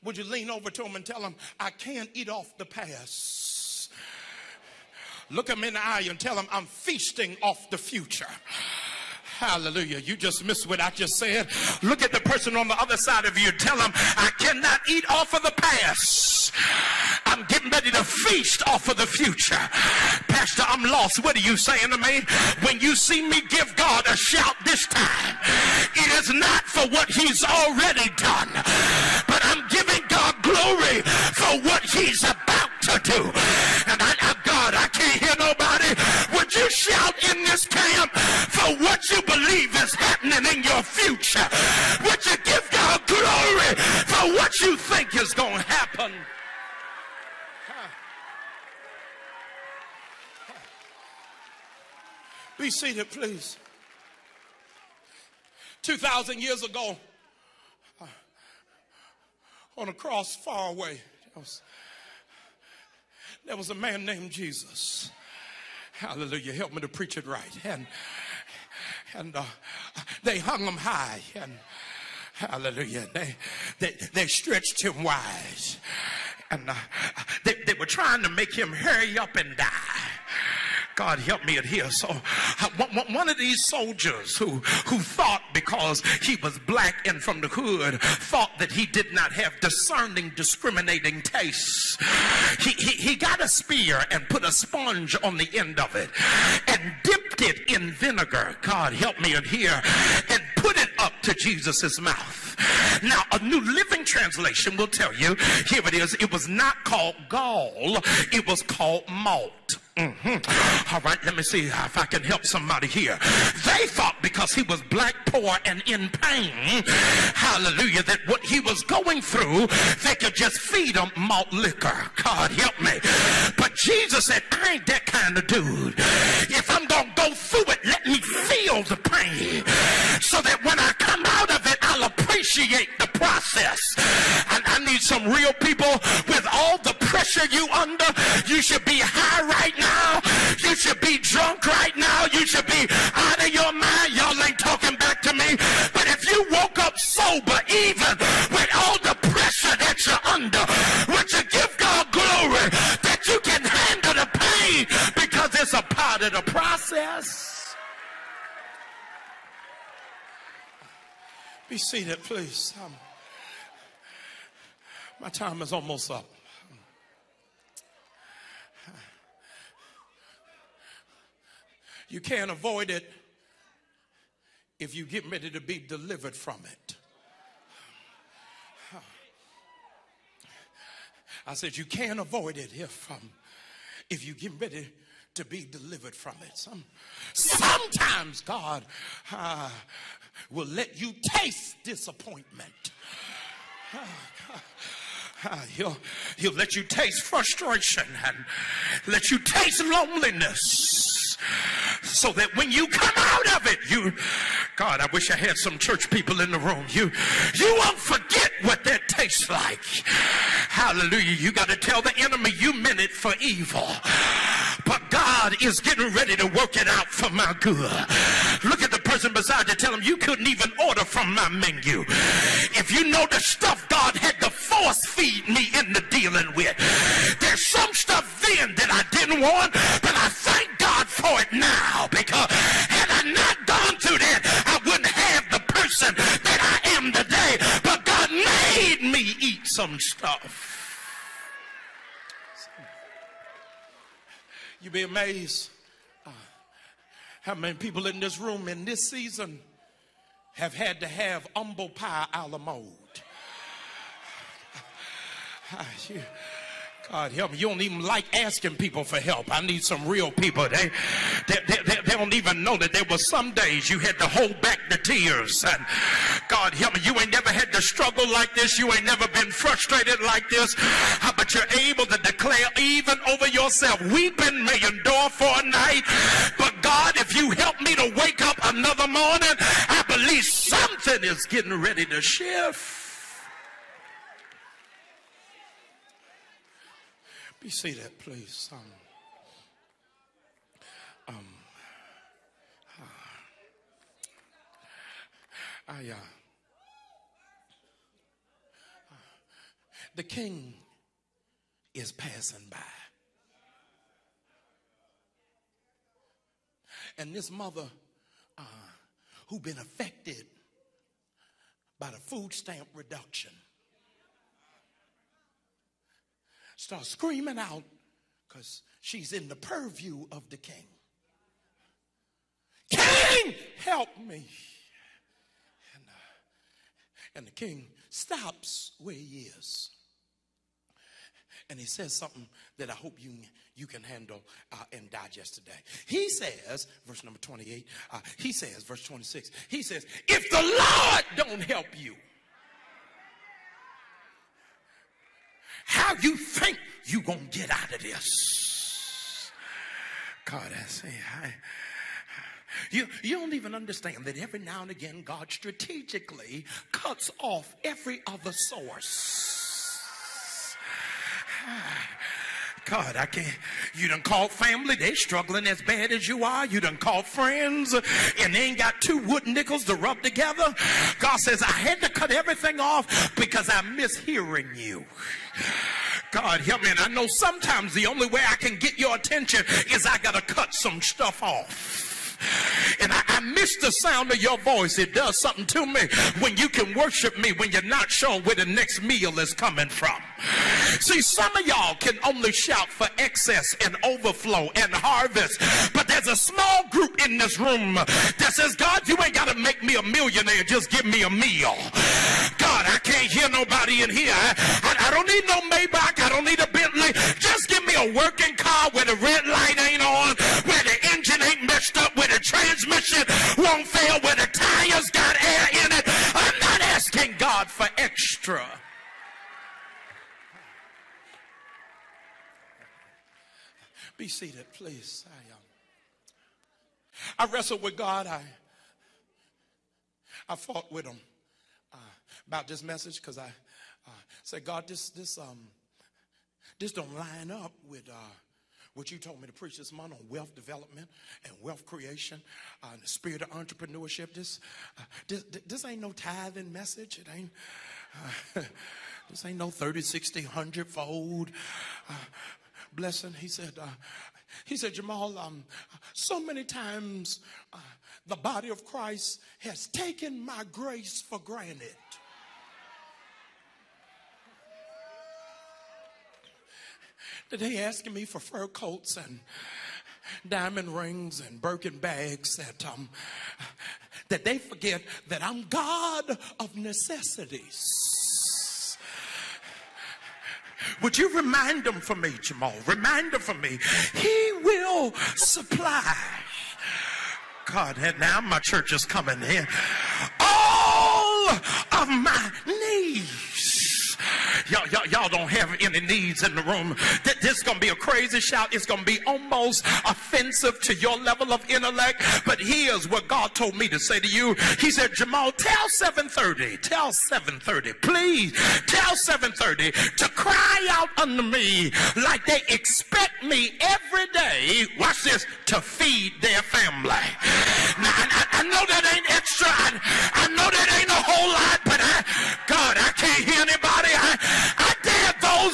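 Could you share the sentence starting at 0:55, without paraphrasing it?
2,000 years ago, uh, on a cross far away, there was, there was a man named Jesus.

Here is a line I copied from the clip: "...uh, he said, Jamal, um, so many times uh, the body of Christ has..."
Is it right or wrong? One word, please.
right.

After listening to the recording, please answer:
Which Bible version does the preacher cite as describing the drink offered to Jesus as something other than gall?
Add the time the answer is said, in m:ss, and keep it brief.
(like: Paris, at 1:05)
New Living Translation, at 1:43.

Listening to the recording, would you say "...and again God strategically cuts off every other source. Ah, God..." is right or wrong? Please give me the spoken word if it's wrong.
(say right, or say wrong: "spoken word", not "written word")
right.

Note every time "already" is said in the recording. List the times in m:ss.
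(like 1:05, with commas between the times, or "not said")
0:27.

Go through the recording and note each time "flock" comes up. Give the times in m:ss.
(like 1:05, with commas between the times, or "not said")
not said.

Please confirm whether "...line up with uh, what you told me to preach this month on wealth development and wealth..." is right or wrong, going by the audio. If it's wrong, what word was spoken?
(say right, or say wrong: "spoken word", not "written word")
right.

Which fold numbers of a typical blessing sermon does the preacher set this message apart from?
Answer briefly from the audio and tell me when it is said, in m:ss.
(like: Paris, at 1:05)
30, 60, 100, at 7:29.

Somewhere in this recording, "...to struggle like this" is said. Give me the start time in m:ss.
4:27.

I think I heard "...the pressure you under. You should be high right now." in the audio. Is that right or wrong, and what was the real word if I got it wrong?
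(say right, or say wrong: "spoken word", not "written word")
right.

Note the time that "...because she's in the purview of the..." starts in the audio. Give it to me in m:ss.
5:18.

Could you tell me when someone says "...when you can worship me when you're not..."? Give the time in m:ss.
6:26.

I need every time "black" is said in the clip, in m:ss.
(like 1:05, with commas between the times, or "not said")
1:26, 1:54.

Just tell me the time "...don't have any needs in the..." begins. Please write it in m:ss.
8:15.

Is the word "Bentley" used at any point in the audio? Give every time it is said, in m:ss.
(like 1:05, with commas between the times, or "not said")
6:46.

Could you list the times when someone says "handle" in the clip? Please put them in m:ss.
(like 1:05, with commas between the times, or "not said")
2:33, 5:34.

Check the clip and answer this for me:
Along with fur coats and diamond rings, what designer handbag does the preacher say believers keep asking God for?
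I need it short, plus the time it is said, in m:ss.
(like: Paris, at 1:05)
Birkin bags, at 7:51.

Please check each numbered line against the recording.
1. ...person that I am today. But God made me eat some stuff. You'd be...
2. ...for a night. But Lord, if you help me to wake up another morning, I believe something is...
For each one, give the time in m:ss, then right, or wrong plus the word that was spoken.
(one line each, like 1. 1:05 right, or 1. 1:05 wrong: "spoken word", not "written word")
1. 3:55 right
2. 4:35 wrong: "God", not "Lord".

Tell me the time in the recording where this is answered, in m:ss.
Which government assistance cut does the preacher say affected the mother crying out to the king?
5:12.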